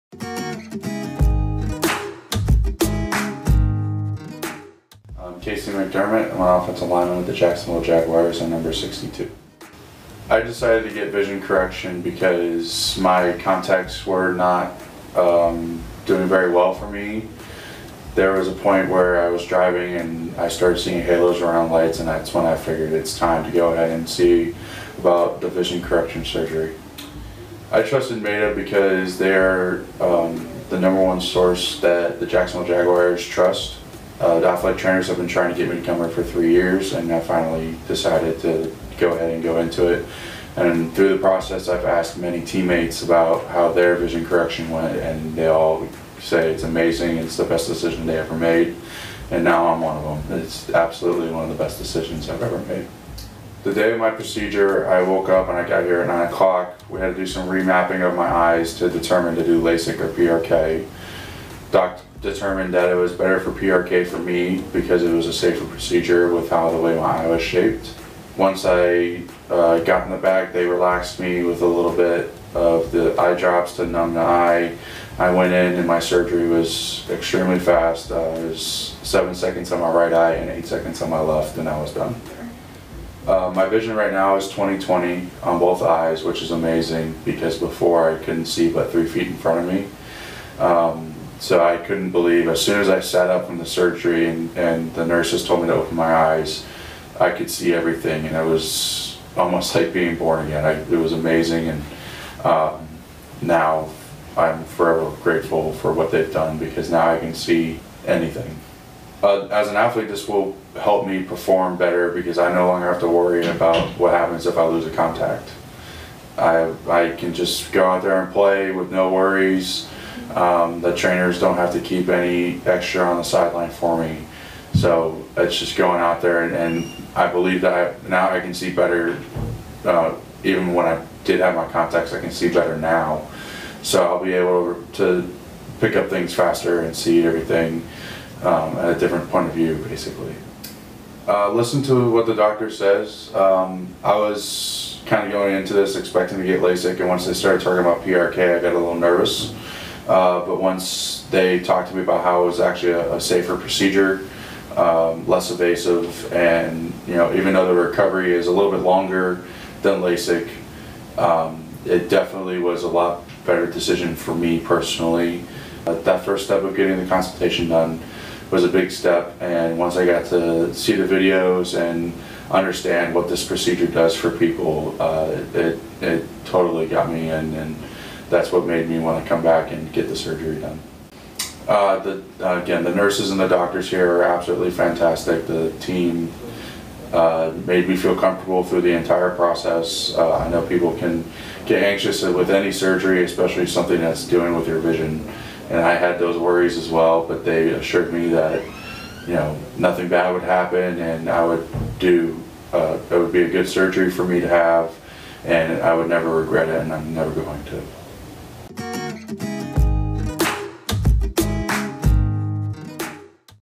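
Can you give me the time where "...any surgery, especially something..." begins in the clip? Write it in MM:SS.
03:12.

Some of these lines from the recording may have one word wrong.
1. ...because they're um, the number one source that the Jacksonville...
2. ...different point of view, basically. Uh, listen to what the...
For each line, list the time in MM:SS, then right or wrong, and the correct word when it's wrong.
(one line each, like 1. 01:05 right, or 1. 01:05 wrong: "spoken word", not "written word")
1. 00:28 right
2. 02:18 right.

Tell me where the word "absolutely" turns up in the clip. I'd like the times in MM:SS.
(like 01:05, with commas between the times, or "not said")
00:50, 03:04.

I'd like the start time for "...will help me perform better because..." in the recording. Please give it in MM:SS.
01:50.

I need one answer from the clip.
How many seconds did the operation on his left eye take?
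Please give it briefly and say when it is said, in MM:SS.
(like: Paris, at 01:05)
8, at 01:20.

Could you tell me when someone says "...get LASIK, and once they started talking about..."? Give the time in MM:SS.
02:26.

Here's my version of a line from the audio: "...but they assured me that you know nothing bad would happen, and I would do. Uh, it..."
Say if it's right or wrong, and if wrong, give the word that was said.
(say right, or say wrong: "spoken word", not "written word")
right.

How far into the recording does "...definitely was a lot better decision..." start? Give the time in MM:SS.
02:42.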